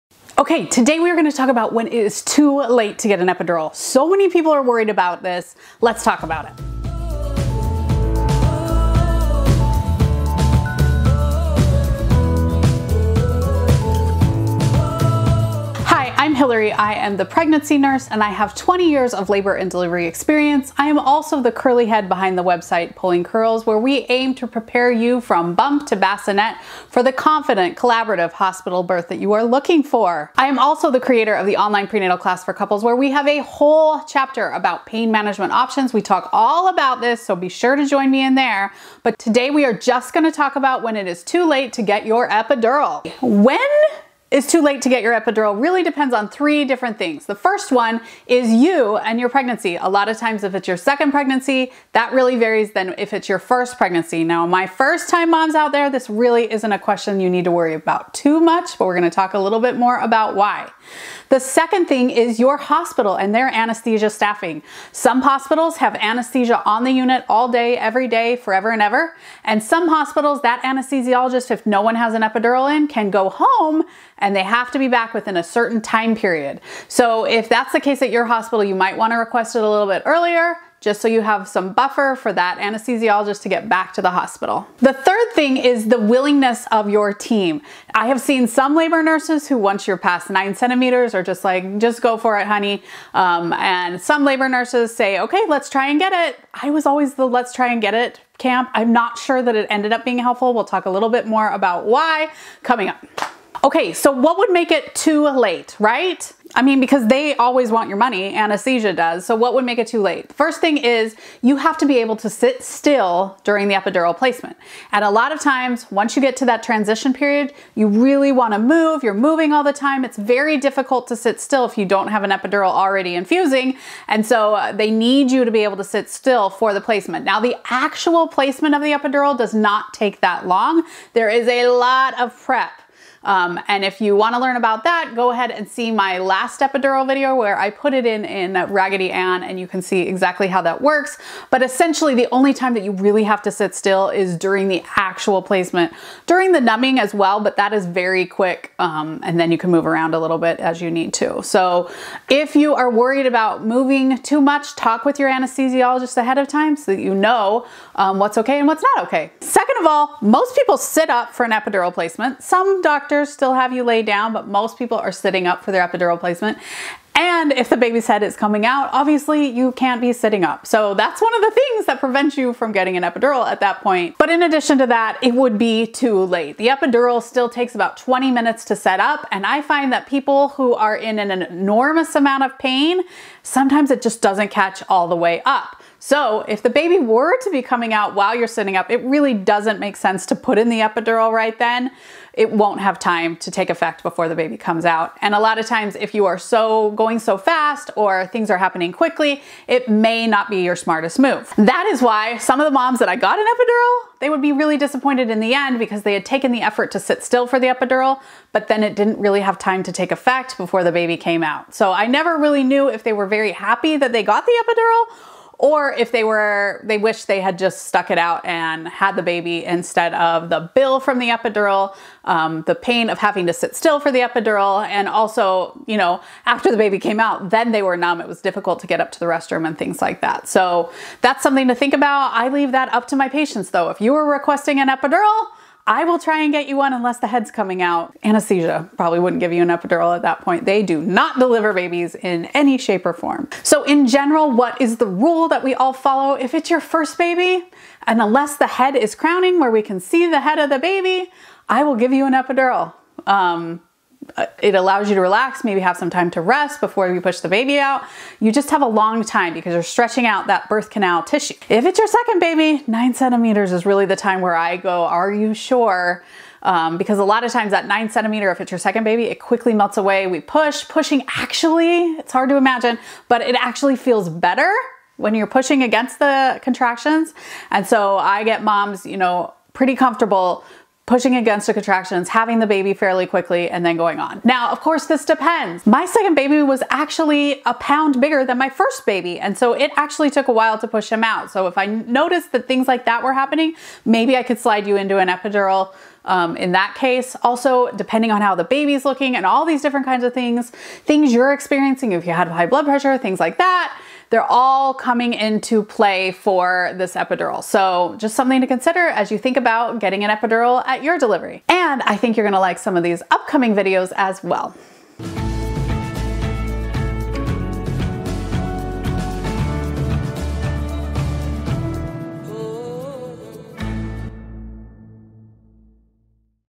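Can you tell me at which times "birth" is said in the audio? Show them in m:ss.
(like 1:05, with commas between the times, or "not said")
0:28, 4:20.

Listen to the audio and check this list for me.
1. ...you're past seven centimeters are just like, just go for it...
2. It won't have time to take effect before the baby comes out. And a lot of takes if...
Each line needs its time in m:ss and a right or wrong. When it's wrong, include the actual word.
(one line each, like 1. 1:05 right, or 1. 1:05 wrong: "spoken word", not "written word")
1. 1:29 wrong: "nine", not "seven"
2. 3:12 wrong: "times", not "takes".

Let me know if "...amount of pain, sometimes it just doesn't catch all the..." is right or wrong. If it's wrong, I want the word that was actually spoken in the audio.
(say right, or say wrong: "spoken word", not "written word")
right.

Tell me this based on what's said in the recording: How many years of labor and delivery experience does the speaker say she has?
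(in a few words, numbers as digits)
20.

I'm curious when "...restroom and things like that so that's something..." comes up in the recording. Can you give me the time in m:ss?
3:49.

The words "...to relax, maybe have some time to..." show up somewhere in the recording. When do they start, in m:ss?
4:15.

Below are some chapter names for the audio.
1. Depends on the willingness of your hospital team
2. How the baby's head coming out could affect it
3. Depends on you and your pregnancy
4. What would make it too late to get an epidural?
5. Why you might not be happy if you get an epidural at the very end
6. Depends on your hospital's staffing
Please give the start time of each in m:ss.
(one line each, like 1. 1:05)
1. 1:26
2. 2:40
3. 0:49
4. 1:45
5. 3:25
6. 1:02.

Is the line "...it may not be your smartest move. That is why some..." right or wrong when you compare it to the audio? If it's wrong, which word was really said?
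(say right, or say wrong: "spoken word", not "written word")
right.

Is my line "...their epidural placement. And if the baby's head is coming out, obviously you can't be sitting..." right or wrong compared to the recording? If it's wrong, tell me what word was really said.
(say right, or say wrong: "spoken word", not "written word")
right.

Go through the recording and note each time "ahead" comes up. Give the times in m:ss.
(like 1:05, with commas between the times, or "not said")
2:15, 2:36.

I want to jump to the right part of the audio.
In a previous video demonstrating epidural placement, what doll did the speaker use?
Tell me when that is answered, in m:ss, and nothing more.
2:18.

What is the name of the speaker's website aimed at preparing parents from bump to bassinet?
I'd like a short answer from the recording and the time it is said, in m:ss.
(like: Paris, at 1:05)
Pulling Curls, at 0:22.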